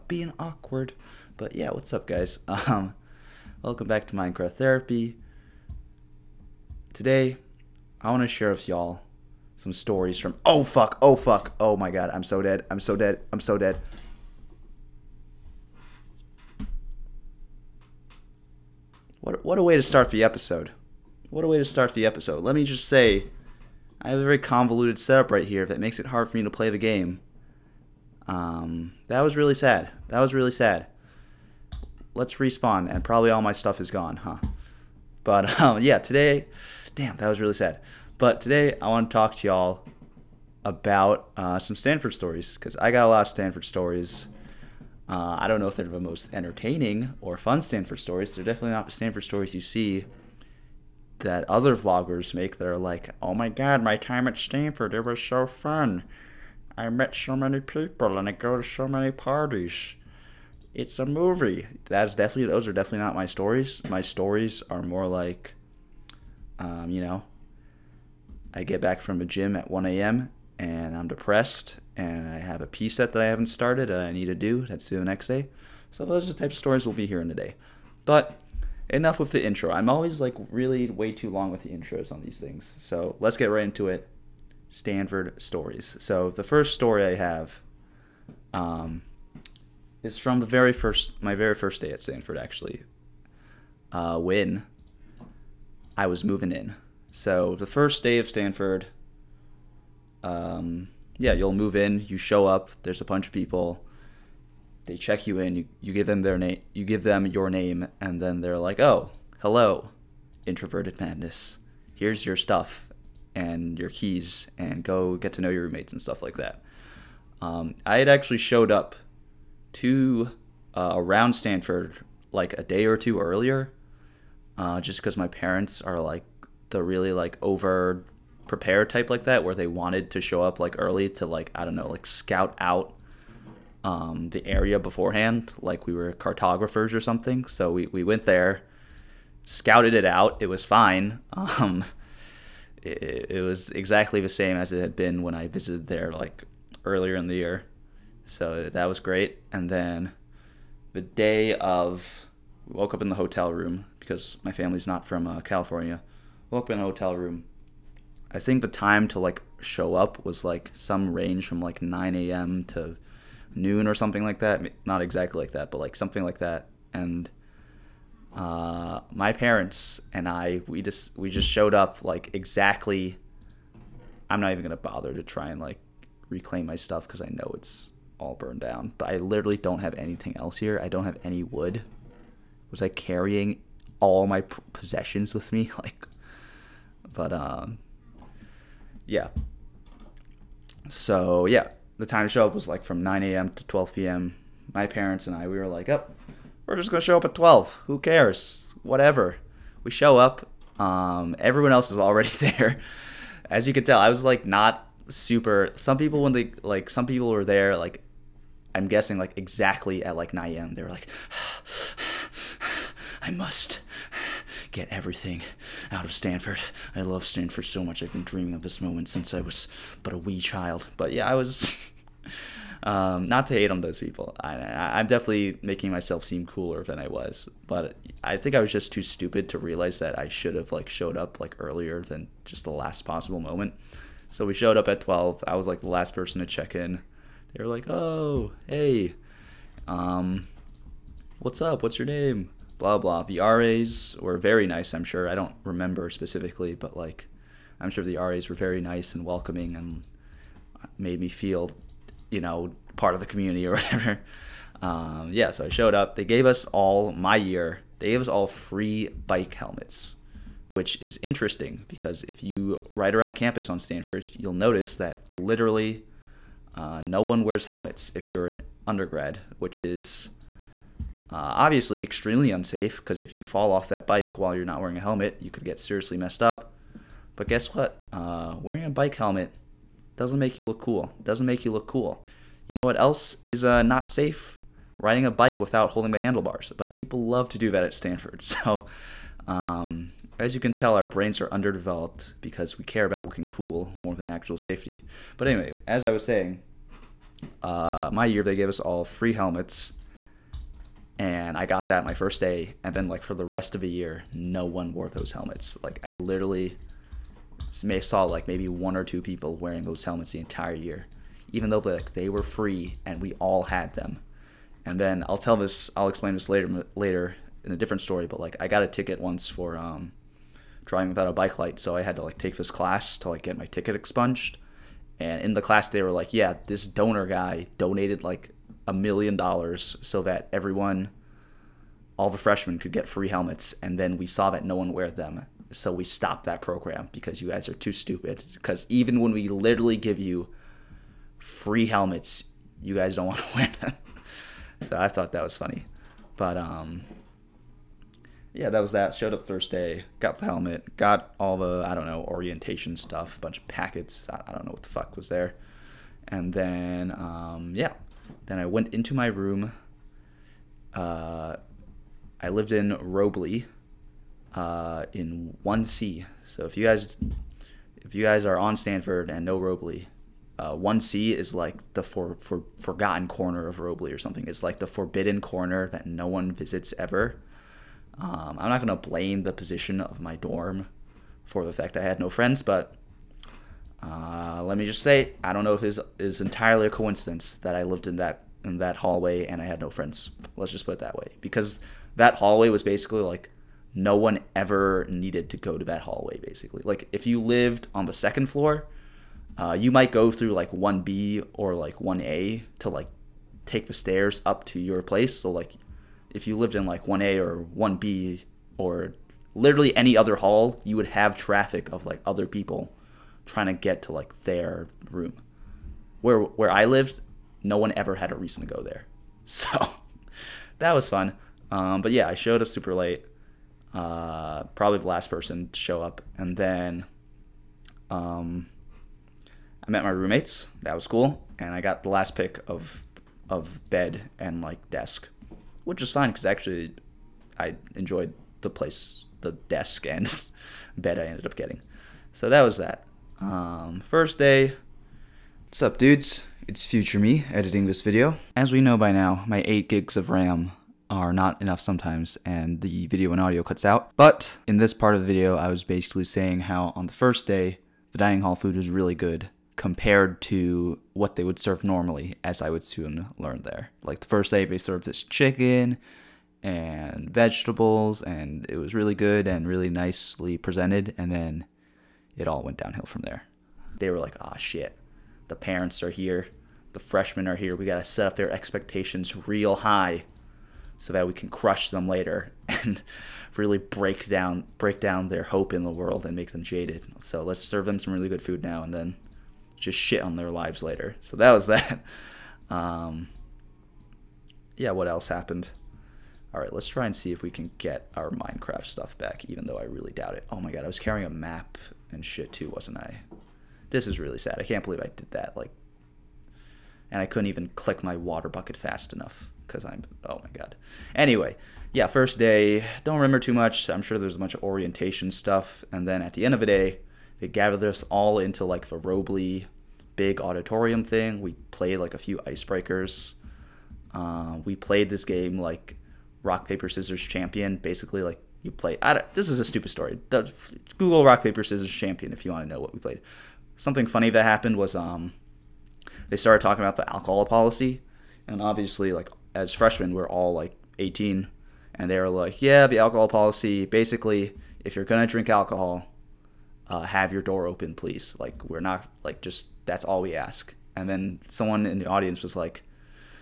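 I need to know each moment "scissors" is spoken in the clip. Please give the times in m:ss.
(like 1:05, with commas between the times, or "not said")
8:46, 8:51.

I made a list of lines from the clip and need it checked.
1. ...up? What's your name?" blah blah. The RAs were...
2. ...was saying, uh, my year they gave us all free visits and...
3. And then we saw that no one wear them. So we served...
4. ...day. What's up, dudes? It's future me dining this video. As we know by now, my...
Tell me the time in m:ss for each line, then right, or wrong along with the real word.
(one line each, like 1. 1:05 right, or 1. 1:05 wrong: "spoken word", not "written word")
1. 4:01 right
2. 4:56 wrong: "helmets", not "visits"
3. 5:33 wrong: "stopped", not "served"
4. 7:24 wrong: "editing", not "dining".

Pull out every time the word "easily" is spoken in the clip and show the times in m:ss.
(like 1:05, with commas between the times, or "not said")
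not said.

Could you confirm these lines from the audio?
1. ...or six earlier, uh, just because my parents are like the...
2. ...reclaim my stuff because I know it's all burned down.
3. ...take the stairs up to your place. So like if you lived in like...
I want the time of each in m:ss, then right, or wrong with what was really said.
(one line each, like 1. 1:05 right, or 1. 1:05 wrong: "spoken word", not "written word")
1. 2:02 wrong: "two", not "six"
2. 2:56 right
3. 6:43 right.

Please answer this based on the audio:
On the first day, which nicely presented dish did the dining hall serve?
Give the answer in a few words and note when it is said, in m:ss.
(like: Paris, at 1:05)
chicken and vegetables, at 7:45.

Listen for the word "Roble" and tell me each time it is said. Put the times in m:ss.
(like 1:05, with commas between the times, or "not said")
6:02, 6:09, 6:13, 8:38.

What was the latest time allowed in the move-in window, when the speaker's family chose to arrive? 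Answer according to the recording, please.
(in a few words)
12 p.m.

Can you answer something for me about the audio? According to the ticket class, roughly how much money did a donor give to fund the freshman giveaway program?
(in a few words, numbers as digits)
a million dollars.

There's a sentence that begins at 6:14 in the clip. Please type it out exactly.
It's like the forbidden corner that no one visits ever.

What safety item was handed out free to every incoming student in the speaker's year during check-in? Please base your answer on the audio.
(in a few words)
bike helmets.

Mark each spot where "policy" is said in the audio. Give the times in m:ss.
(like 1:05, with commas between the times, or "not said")
8:57, 9:03.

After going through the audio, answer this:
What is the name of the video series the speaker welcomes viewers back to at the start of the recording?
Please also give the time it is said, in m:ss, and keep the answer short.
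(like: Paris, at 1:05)
Minecraft Therapy, at 0:04.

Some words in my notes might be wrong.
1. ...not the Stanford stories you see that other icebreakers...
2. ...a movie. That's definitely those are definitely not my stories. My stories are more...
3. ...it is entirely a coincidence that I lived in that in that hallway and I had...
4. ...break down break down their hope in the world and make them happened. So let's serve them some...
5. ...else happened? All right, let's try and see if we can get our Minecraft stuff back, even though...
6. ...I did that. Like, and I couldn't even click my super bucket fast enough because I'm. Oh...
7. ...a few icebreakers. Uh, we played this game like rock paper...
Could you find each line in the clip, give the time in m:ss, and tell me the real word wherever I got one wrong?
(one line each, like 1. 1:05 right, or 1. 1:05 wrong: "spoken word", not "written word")
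1. 0:48 wrong: "vloggers", not "icebreakers"
2. 1:00 right
3. 6:25 right
4. 8:03 wrong: "jaded", not "happened"
5. 8:15 right
6. 8:24 wrong: "water", not "super"
7. 8:42 right.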